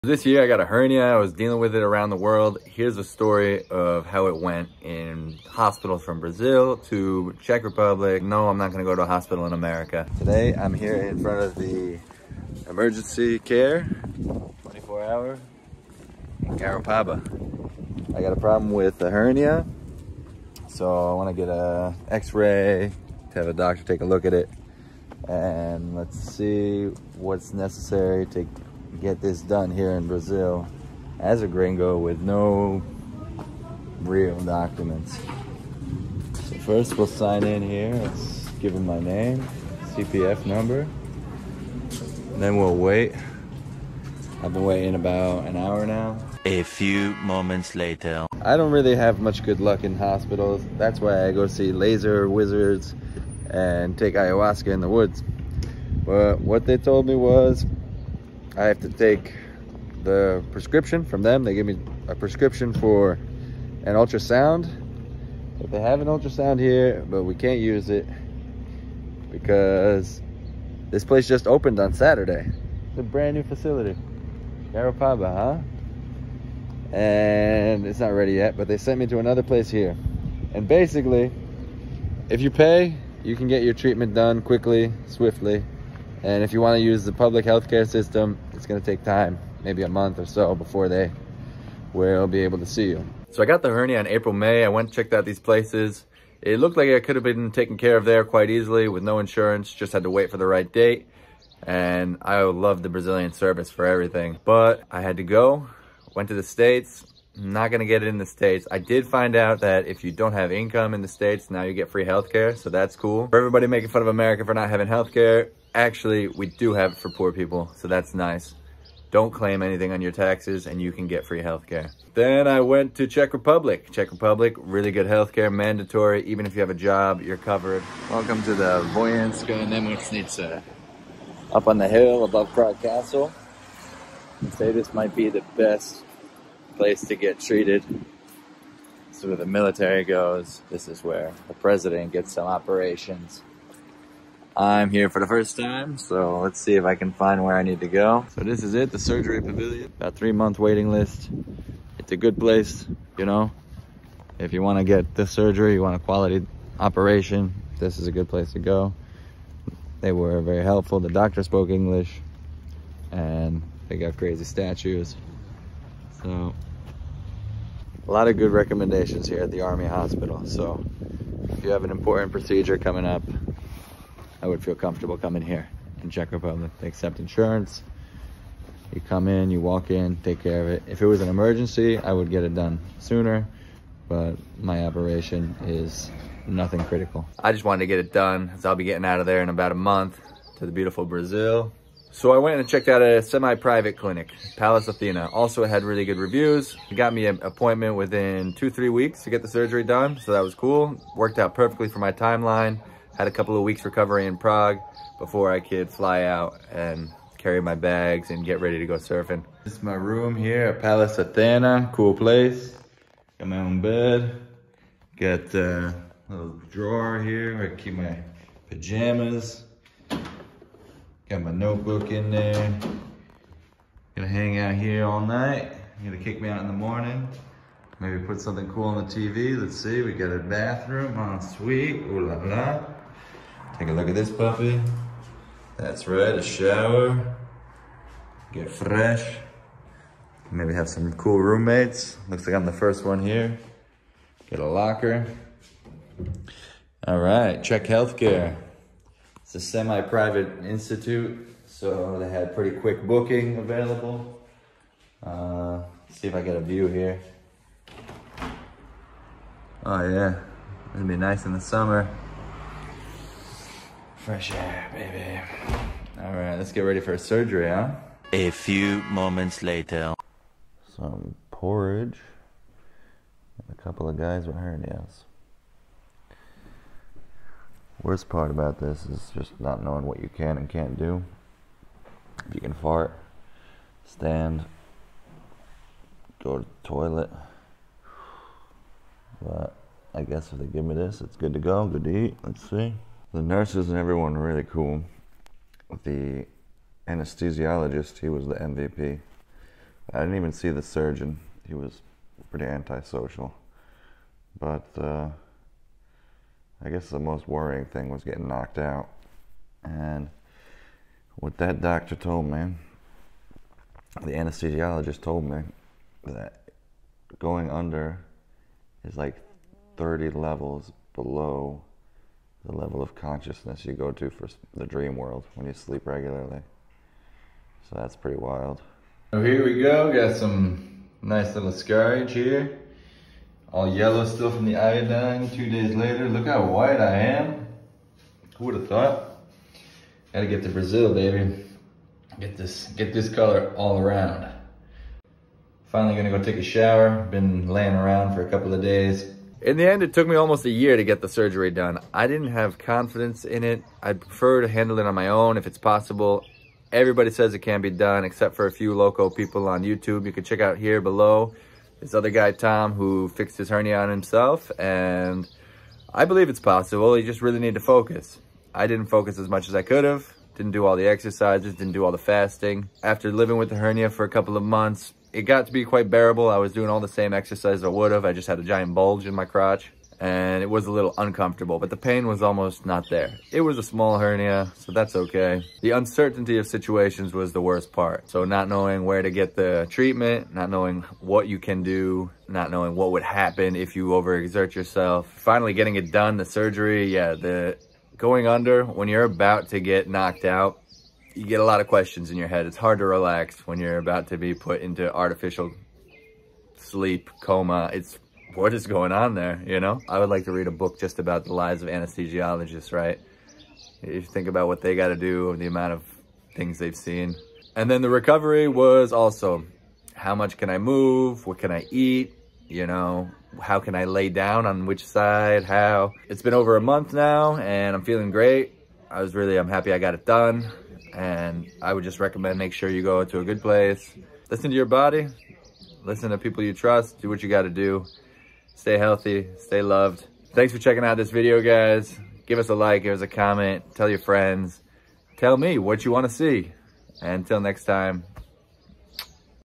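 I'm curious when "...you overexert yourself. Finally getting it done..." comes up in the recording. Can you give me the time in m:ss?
6:33.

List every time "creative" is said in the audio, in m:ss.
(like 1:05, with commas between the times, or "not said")
not said.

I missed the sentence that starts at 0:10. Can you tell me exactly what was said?
Today I'm here in front of the emergency care, 24 hour, in Garopaba.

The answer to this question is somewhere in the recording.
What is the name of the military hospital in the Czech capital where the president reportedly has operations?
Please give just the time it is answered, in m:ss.
2:08.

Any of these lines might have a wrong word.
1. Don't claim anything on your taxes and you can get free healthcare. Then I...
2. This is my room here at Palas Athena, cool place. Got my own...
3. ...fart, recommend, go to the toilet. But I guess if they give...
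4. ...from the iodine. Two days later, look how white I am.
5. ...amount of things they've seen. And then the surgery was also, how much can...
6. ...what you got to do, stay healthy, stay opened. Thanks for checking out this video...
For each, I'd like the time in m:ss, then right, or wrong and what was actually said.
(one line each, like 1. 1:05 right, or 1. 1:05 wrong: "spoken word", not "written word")
1. 1:59 right
2. 3:29 right
3. 4:42 wrong: "stand", not "recommend"
4. 5:34 right
5. 6:55 wrong: "recovery", not "surgery"
6. 7:17 wrong: "loved", not "opened".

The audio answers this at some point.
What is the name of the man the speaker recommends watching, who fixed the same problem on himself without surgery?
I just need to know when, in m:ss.
6:02.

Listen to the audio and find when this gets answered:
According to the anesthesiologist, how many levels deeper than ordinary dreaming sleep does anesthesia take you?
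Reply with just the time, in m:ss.
5:19.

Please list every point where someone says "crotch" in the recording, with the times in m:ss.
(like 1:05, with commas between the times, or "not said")
6:19.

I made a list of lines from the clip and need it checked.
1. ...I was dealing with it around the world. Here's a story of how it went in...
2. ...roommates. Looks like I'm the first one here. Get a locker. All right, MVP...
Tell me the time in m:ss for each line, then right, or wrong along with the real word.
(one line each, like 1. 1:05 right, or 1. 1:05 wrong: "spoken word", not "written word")
1. 0:01 right
2. 4:01 wrong: "Czech", not "MVP".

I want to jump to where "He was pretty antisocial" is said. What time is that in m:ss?
5:01.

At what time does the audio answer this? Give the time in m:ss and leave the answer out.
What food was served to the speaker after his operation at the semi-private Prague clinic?
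4:31.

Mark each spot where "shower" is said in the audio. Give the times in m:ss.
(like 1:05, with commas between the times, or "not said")
3:56, 5:46.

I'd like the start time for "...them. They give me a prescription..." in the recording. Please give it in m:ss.
1:01.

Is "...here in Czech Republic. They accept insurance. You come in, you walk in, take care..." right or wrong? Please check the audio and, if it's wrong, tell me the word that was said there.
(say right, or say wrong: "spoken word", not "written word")
right.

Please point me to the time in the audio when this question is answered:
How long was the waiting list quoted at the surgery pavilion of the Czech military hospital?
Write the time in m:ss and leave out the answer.
2:30.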